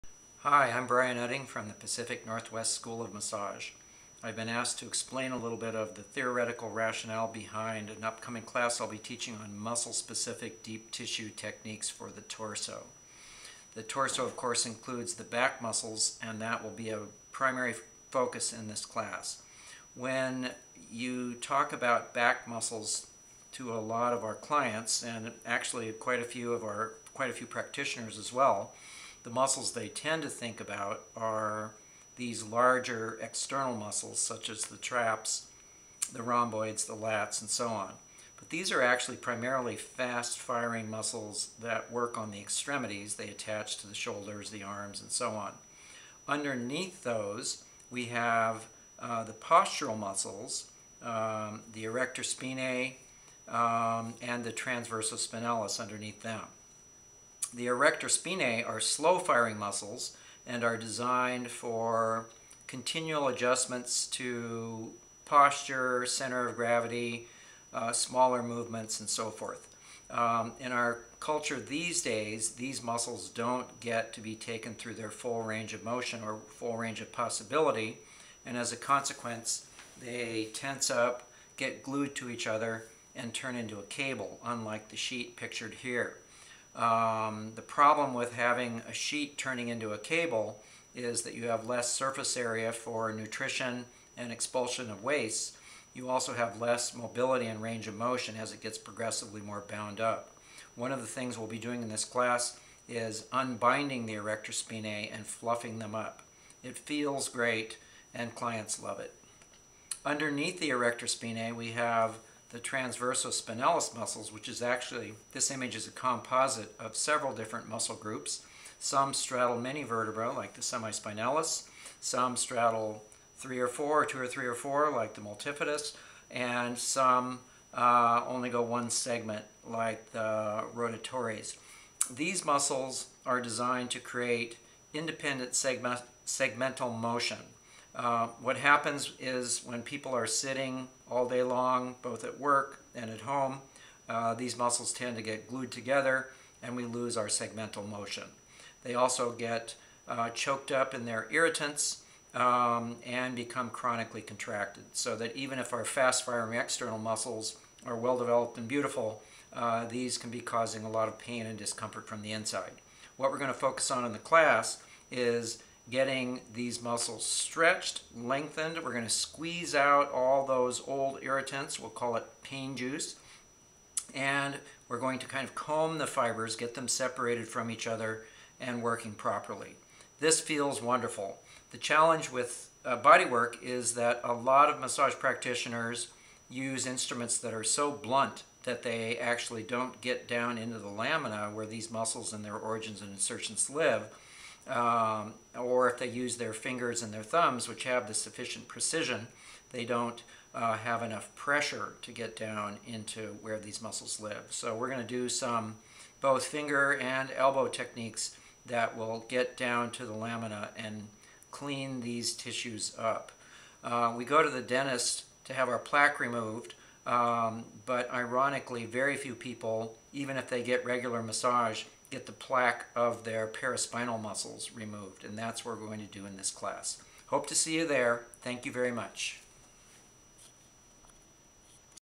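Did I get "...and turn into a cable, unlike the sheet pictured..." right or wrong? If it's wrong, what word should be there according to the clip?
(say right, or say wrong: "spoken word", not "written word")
right.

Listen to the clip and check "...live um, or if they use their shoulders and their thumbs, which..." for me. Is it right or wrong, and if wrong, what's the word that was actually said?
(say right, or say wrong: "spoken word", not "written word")
wrong: "fingers", not "shoulders".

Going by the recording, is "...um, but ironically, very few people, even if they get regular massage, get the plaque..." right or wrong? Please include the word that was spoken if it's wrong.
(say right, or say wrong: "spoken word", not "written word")
right.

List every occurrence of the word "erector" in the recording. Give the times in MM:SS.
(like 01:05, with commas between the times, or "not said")
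00:51, 00:57, 01:44, 01:50.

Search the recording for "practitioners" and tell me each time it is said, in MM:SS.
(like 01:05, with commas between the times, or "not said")
00:27, 03:05.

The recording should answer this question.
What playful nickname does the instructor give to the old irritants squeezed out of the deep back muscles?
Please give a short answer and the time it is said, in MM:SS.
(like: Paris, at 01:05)
pain juice, at 02:52.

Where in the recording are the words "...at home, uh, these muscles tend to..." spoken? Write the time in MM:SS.
02:23.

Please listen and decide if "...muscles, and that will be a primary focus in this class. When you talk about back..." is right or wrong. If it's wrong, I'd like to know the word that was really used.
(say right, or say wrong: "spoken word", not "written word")
right.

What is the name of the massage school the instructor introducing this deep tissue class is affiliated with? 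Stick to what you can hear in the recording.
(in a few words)
Pacific Northwest School of Massage.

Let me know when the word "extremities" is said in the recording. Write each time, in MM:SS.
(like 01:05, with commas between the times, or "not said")
00:42.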